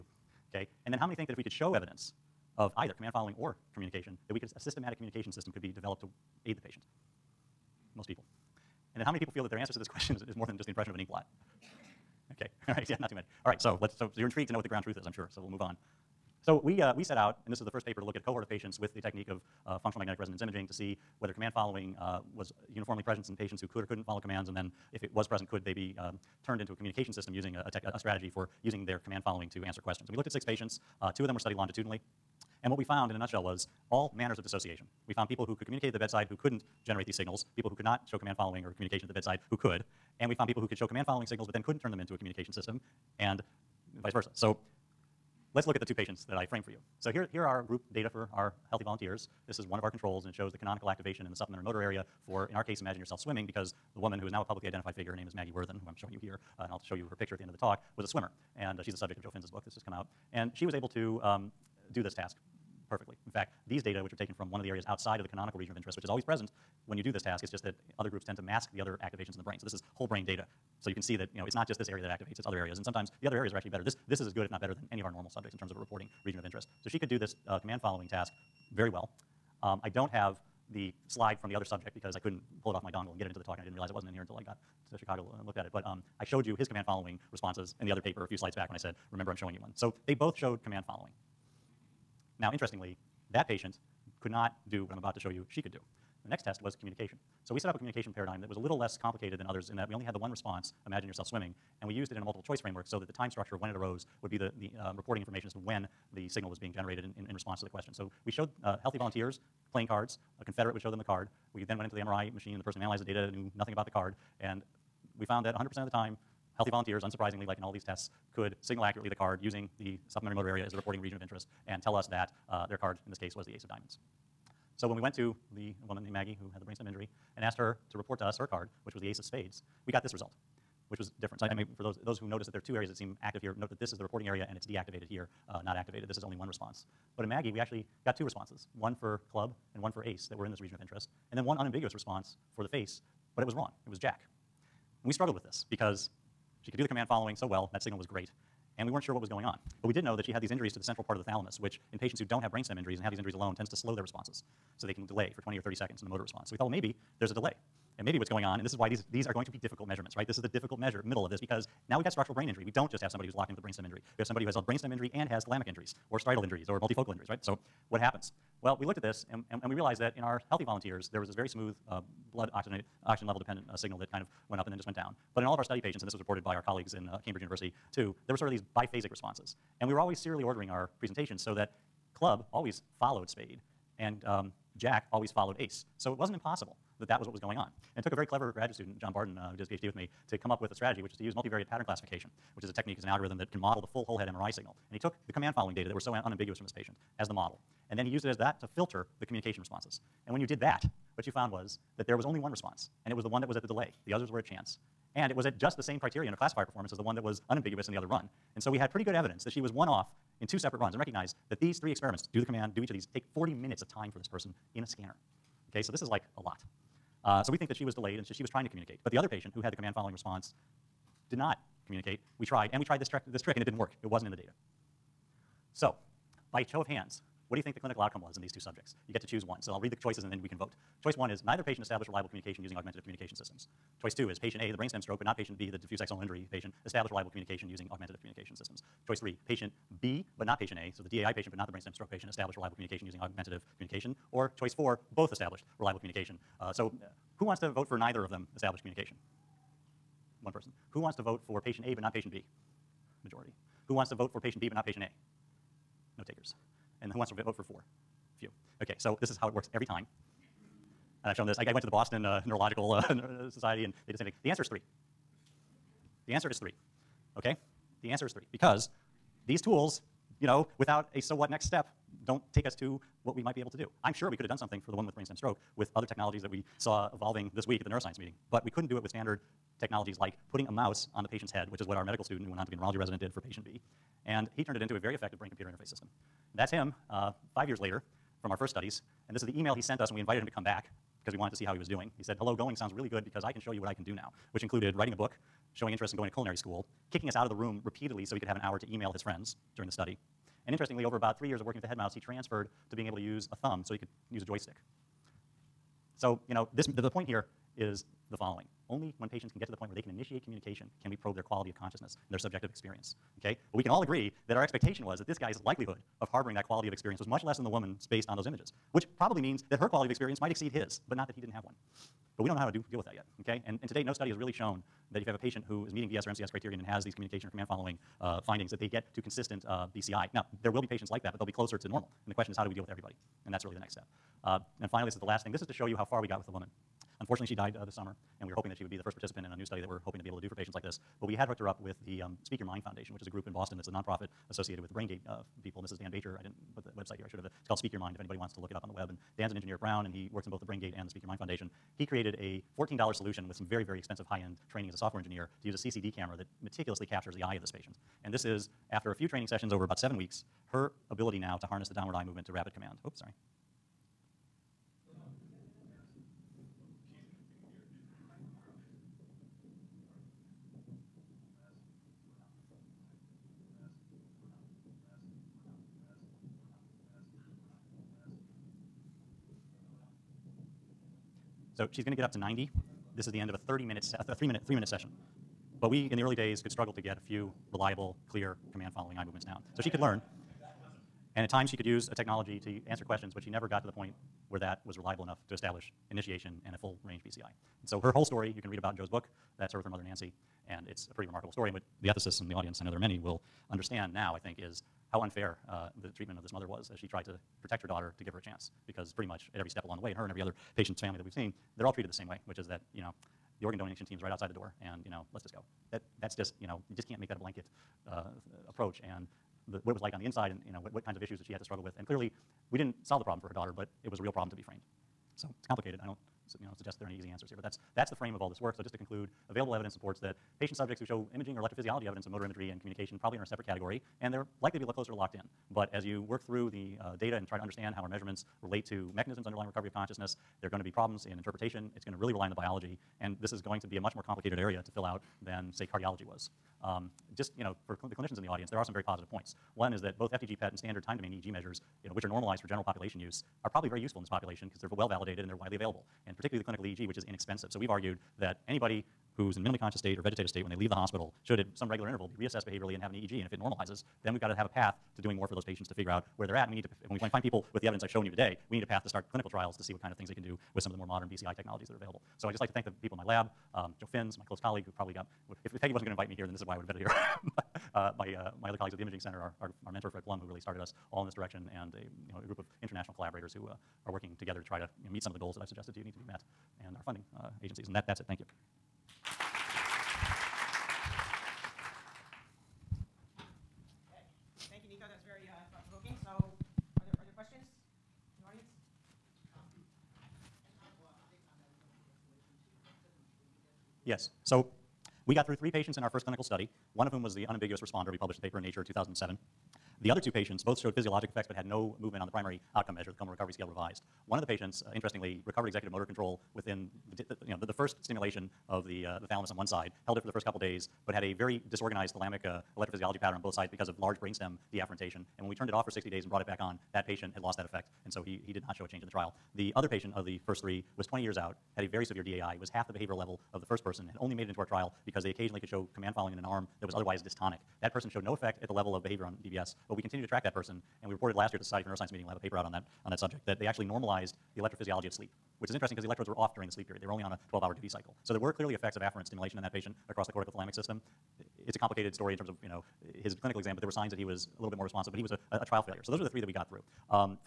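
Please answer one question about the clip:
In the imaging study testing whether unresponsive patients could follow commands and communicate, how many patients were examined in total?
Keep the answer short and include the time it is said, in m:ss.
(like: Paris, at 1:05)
6, at 0:30.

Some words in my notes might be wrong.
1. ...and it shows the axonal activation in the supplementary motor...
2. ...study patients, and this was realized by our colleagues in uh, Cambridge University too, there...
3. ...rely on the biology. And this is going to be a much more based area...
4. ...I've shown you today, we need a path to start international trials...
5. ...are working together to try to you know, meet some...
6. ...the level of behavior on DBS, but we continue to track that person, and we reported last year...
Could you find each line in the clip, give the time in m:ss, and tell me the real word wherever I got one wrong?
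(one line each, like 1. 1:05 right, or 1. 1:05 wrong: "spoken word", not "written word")
1. 0:50 wrong: "canonical", not "axonal"
2. 2:55 wrong: "reported", not "realized"
3. 7:22 wrong: "complicated", not "based"
4. 7:48 wrong: "clinical", not "international"
5. 8:04 right
6. 8:58 right.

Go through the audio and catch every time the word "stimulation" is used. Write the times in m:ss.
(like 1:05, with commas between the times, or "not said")
8:38, 9:09.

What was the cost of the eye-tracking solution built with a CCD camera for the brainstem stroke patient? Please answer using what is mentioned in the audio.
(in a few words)
$14.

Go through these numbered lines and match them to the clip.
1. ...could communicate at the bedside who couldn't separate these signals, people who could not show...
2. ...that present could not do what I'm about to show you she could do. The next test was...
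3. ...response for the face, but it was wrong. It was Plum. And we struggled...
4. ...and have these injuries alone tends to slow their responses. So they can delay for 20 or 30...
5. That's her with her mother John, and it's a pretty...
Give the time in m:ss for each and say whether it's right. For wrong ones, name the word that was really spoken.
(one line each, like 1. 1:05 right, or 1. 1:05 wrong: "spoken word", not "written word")
1. 0:35 wrong: "generate", not "separate"
2. 1:33 wrong: "patient", not "present"
3. 2:21 wrong: "Jack", not "Plum"
4. 2:32 right
5. 6:39 wrong: "Nancy", not "John".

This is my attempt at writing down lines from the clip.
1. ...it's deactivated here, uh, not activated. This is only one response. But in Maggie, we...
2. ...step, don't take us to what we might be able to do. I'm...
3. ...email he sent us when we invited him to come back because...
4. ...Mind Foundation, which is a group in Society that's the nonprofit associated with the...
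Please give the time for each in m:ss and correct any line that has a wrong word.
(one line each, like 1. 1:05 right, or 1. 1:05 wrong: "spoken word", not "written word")
1. 2:14 right
2. 4:31 right
3. 4:49 right
4. 5:42 wrong: "Boston", not "Society".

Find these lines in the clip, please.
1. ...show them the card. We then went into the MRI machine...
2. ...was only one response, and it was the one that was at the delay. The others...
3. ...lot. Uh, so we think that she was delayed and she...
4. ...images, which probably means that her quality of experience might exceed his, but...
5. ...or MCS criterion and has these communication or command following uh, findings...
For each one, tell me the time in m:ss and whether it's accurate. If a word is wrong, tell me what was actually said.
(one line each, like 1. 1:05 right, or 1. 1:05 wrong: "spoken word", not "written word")
1. 1:50 right
2. 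3:22 right
3. 3:36 right
4. 5:18 right
5. 5:26 right.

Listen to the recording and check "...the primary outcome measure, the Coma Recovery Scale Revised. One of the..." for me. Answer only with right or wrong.
right.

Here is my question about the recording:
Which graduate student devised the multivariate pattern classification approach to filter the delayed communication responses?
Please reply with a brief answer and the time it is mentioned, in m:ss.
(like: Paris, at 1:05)
John Bardin, at 3:08.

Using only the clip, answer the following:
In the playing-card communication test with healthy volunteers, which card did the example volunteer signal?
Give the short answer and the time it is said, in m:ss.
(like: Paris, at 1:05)
Ace of diamonds, at 2:03.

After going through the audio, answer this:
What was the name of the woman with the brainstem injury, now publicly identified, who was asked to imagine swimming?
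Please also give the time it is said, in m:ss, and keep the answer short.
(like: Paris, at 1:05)
Maggie Worthen, at 0:55.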